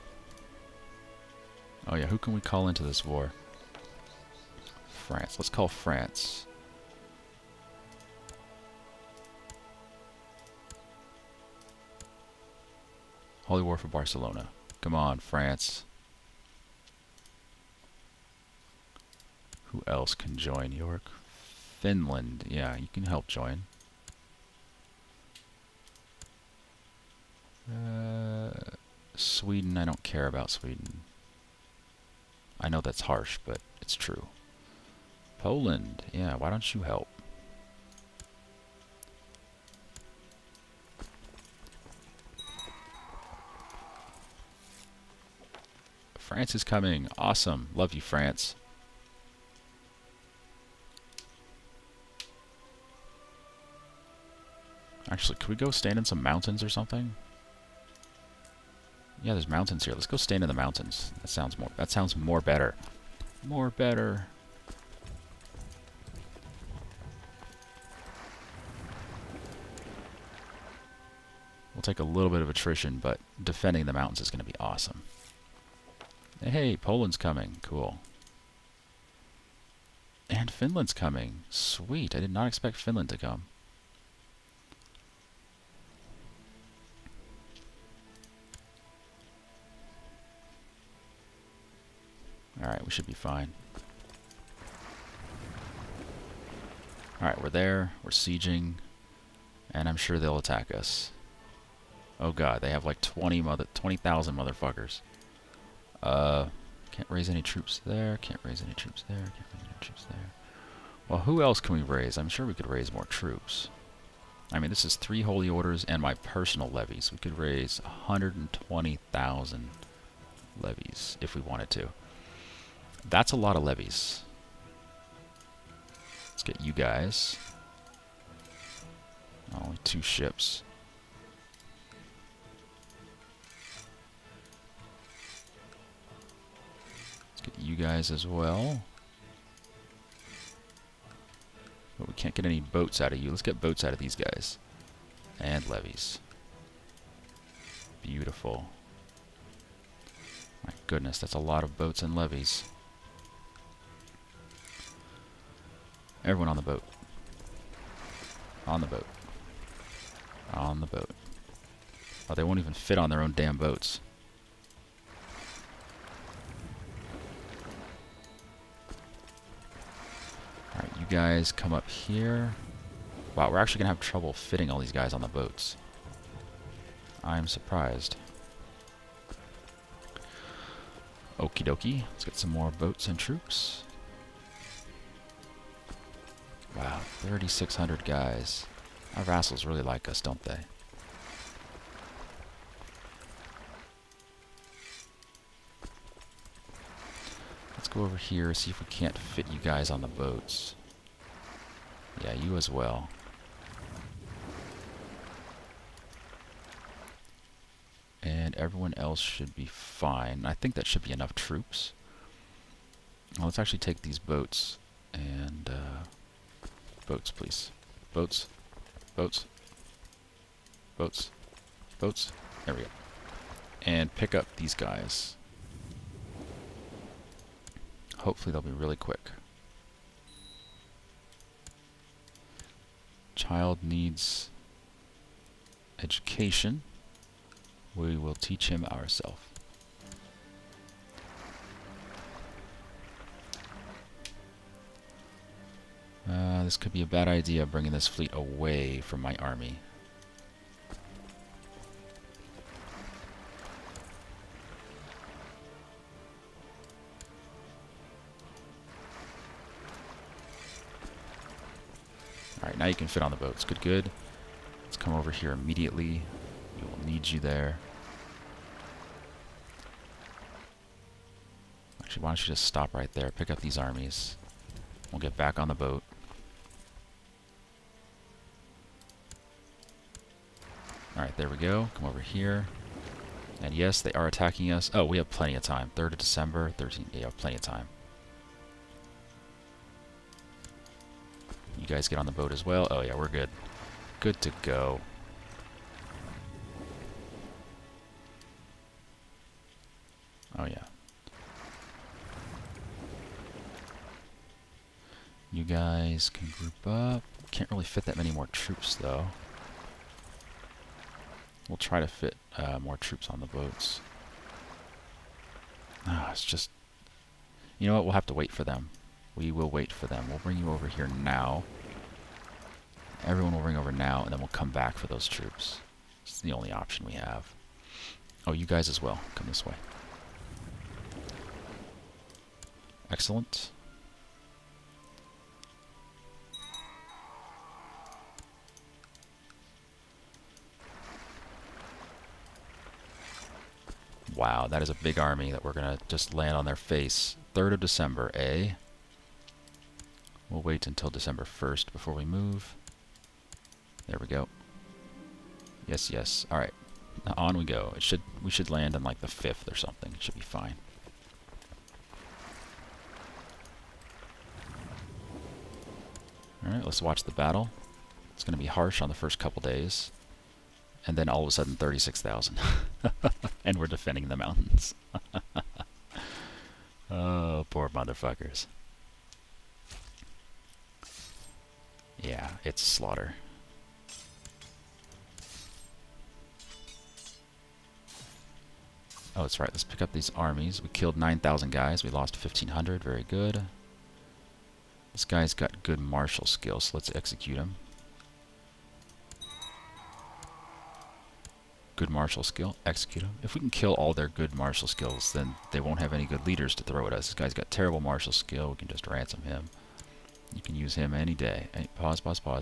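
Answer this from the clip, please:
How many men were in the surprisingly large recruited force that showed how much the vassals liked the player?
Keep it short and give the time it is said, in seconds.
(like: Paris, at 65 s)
3,600, at 187 s.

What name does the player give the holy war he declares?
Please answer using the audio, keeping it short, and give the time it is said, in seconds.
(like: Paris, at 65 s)
Holy War for Barcelona, at 13 s.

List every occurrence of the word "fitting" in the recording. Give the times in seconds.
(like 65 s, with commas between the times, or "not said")
174 s.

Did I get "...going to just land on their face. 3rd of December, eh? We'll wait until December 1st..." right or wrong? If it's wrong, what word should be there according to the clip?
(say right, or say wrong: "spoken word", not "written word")
right.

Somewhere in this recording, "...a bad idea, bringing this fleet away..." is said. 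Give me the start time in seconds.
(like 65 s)
247 s.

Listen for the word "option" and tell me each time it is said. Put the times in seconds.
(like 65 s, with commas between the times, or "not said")
326 s.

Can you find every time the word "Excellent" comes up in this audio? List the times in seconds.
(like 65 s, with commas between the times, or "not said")
333 s.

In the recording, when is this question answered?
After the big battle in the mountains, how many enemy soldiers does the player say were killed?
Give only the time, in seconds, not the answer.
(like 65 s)
391 s.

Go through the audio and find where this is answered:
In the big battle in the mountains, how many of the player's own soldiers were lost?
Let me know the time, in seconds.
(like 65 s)
392 s.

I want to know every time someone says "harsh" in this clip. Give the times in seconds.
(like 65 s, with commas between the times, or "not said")
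33 s, 368 s.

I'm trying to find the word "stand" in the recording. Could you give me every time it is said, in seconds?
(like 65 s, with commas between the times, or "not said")
55 s, 60 s.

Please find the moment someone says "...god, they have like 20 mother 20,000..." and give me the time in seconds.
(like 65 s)
102 s.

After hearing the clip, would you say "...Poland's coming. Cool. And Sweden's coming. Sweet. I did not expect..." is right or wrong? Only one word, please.
wrong.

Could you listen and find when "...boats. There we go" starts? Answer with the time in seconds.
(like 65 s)
221 s.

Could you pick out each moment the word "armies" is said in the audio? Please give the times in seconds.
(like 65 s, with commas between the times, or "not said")
273 s, 390 s.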